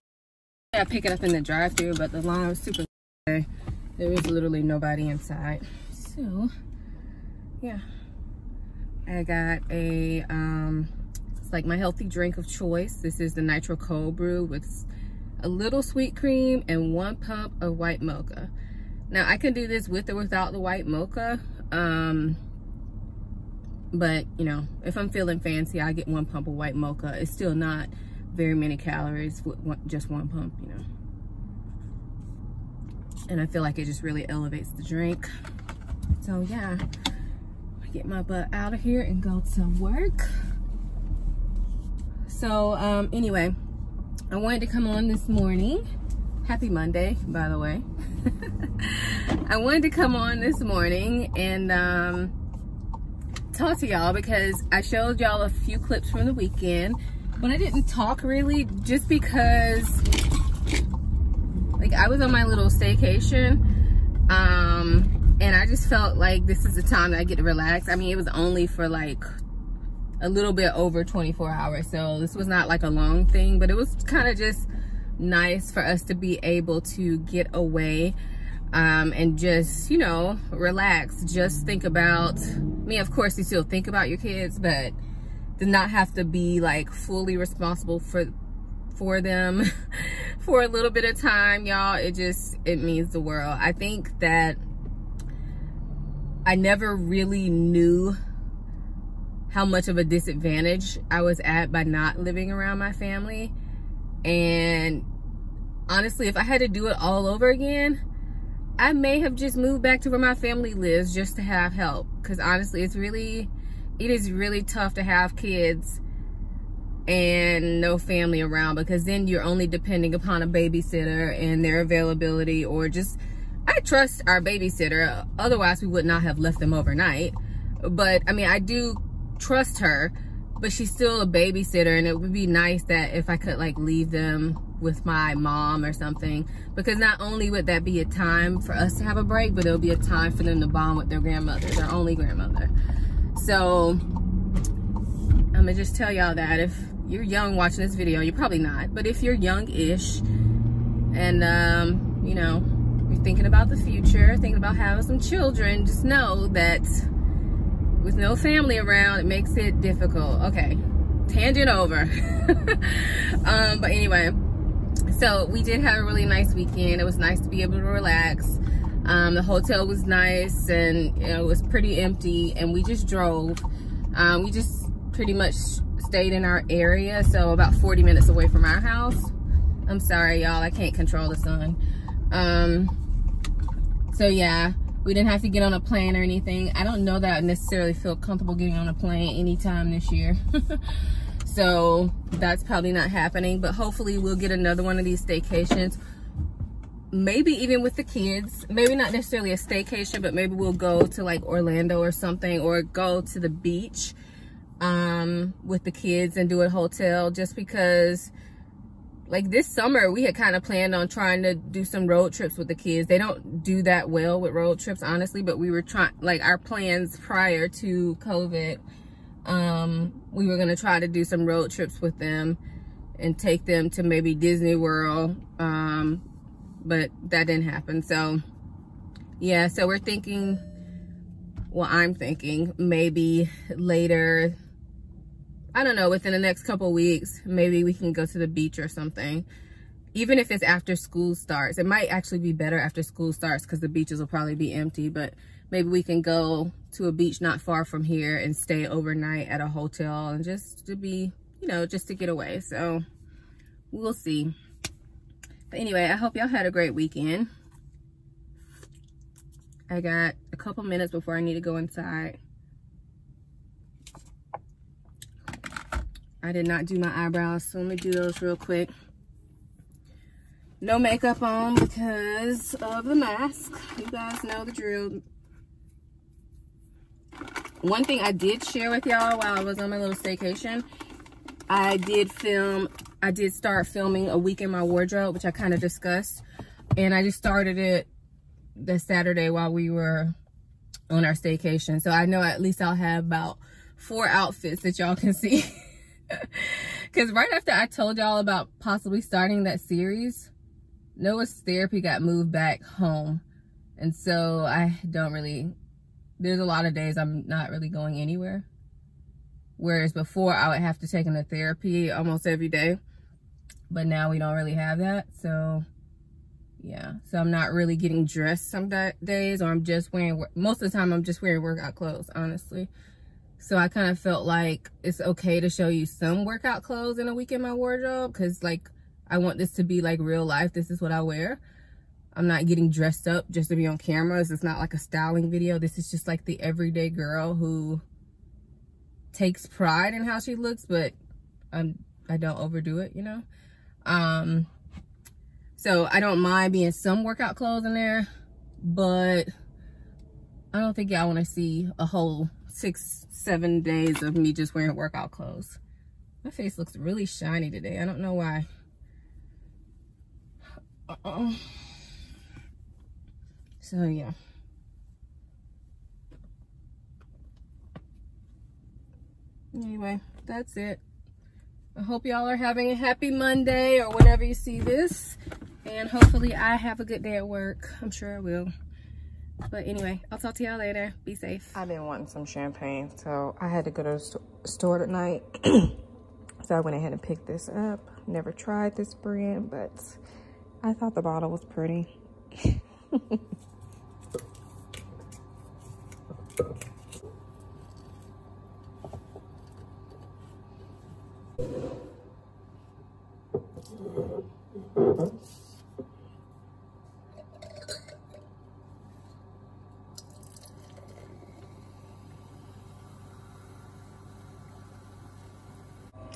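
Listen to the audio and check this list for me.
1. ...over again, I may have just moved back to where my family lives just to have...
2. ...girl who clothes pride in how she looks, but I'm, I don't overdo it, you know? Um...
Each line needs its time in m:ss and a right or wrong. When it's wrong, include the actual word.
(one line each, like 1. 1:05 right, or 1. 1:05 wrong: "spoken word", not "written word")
1. 1:47 right
2. 5:37 wrong: "takes", not "clothes".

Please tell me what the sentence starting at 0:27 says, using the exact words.
It's still not very many calories with one, just one pump, you know.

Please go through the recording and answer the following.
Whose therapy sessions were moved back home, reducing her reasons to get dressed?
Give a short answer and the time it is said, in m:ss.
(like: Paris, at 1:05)
Noah, at 5:01.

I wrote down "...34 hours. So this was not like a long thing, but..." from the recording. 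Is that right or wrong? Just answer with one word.
wrong.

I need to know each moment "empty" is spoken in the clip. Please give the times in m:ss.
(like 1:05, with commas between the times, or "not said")
2:51, 4:04.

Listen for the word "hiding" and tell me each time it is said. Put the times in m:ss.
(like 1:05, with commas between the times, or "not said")
not said.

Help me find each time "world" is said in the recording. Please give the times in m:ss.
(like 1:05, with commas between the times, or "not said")
1:33, 3:44.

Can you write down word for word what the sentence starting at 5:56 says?
My face looks really shiny today.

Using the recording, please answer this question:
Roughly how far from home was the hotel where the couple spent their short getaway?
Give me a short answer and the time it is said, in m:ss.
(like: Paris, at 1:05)
40 minutes, at 2:57.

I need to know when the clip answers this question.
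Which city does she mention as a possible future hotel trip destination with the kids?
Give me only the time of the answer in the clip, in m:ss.
3:21.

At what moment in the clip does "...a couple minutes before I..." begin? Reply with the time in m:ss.
4:20.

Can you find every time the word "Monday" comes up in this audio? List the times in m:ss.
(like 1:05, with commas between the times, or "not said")
0:46, 6:13.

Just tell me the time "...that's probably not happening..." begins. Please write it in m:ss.
3:12.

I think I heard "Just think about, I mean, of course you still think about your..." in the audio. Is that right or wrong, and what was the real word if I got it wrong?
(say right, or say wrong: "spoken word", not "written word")
right.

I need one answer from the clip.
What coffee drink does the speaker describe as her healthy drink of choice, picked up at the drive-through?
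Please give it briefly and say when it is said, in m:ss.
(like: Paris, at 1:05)
Nitro Cold Brew, at 0:13.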